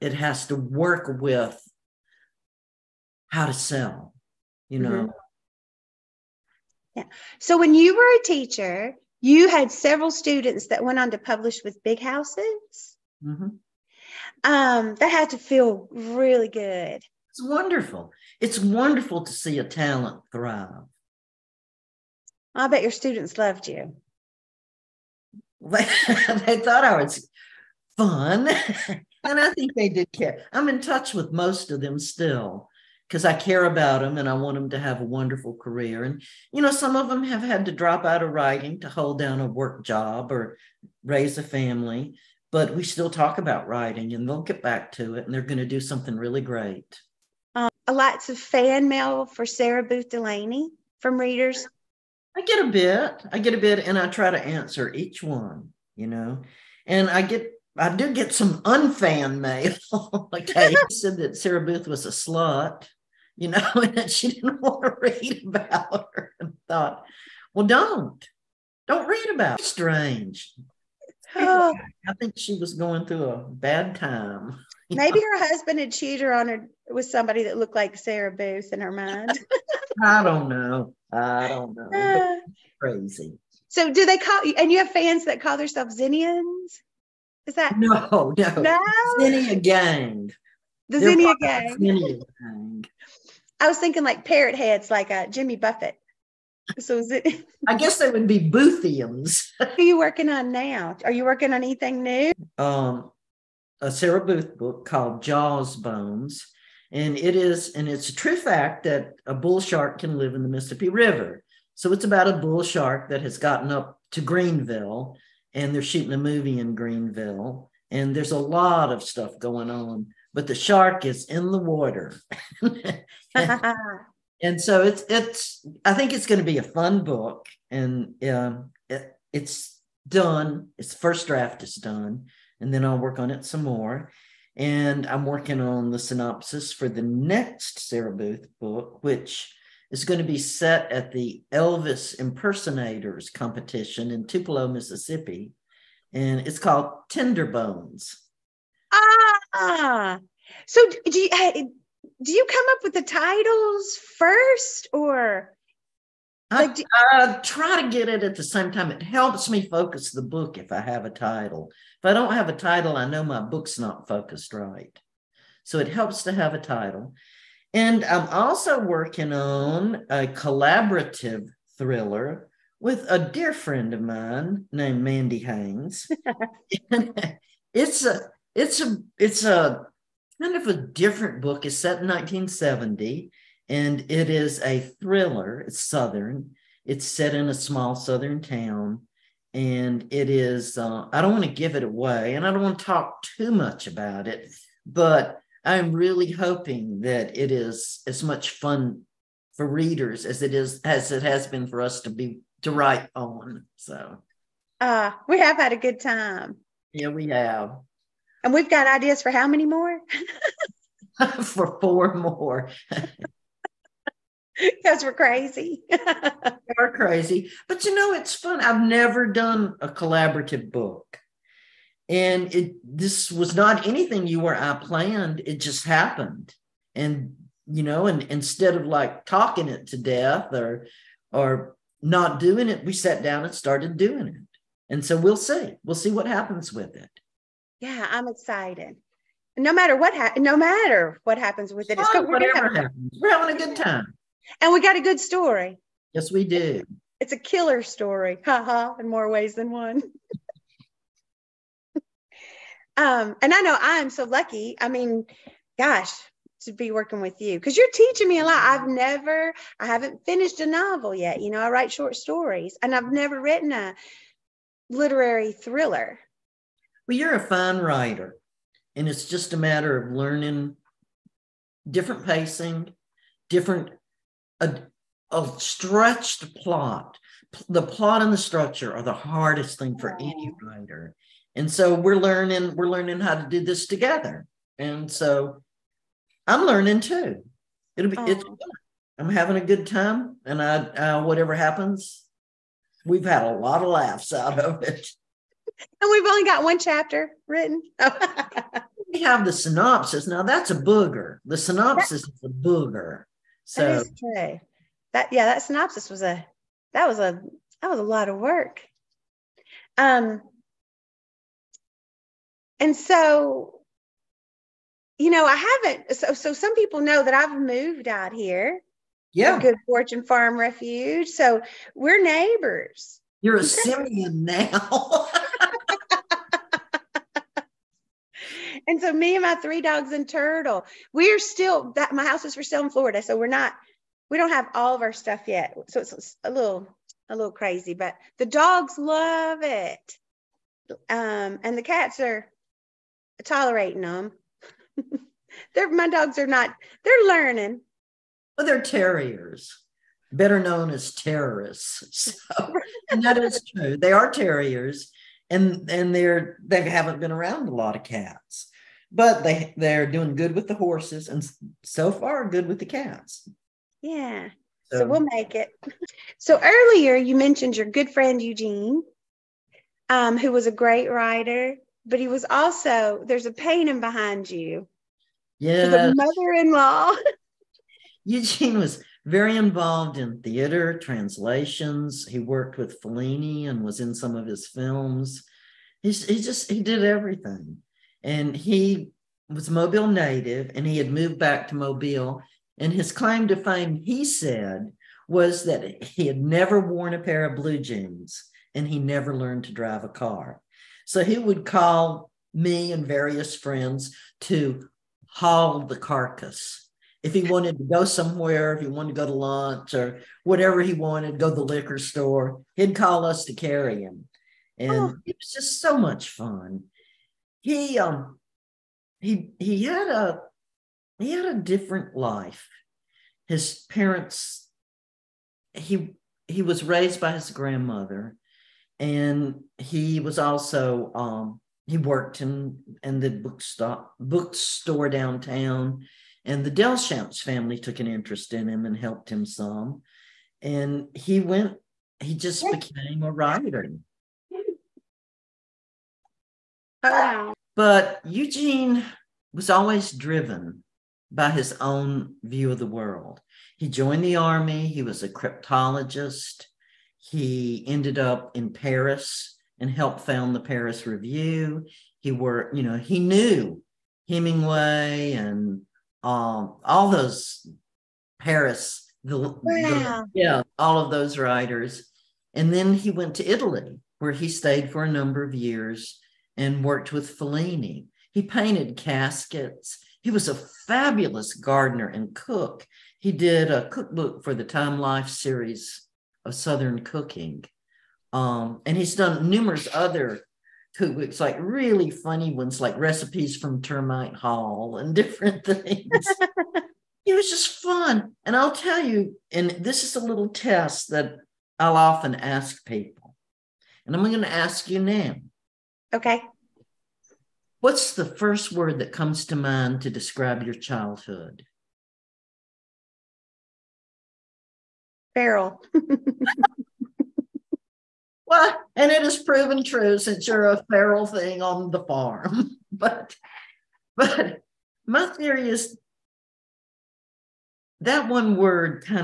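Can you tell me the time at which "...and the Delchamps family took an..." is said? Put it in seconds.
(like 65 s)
436 s.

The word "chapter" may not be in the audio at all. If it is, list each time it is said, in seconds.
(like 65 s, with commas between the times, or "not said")
296 s.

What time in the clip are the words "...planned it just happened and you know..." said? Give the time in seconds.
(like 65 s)
224 s.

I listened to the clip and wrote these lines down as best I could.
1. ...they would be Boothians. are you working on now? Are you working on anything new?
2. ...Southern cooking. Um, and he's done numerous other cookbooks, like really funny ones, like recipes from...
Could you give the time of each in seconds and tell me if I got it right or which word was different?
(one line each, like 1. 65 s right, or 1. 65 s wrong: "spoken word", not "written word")
1. 97 s right
2. 486 s right.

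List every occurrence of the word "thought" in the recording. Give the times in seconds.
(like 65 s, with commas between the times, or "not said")
26 s, 66 s.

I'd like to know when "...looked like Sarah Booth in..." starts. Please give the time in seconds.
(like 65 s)
77 s.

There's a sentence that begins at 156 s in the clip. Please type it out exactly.
Like, do- I, I try to get it at the same time.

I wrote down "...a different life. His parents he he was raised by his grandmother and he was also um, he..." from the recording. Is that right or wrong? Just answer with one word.
right.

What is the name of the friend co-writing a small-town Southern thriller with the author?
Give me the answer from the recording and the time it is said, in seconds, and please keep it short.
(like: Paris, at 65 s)
Mandy Haynes, at 175 s.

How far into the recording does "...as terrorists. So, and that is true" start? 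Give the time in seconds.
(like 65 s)
350 s.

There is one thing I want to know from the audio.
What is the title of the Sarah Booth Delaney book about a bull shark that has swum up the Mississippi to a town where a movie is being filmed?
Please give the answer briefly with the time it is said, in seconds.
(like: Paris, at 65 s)
Jaws Bones, at 105 s.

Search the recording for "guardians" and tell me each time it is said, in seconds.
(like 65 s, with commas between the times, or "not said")
not said.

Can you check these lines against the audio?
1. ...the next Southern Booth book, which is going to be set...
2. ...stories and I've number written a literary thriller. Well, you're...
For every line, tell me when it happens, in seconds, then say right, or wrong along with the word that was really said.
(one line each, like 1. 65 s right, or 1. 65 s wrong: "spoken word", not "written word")
1. 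136 s wrong: "Sarah", not "Southern"
2. 262 s wrong: "never", not "number".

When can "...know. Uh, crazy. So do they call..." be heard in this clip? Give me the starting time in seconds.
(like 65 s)
81 s.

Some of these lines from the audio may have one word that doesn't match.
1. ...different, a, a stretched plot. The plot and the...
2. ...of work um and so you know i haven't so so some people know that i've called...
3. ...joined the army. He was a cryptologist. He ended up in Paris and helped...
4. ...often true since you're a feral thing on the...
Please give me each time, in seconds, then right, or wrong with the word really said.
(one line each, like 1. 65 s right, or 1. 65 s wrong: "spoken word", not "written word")
1. 273 s right
2. 308 s wrong: "moved", not "called"
3. 453 s right
4. 519 s wrong: "proven", not "often".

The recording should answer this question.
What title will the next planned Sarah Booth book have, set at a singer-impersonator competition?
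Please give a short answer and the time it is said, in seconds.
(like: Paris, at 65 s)
Tender Bones, at 147 s.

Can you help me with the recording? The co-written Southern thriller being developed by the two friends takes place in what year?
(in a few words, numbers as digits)
1970.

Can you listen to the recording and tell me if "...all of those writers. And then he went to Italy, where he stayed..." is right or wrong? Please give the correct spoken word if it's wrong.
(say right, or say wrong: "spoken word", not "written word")
right.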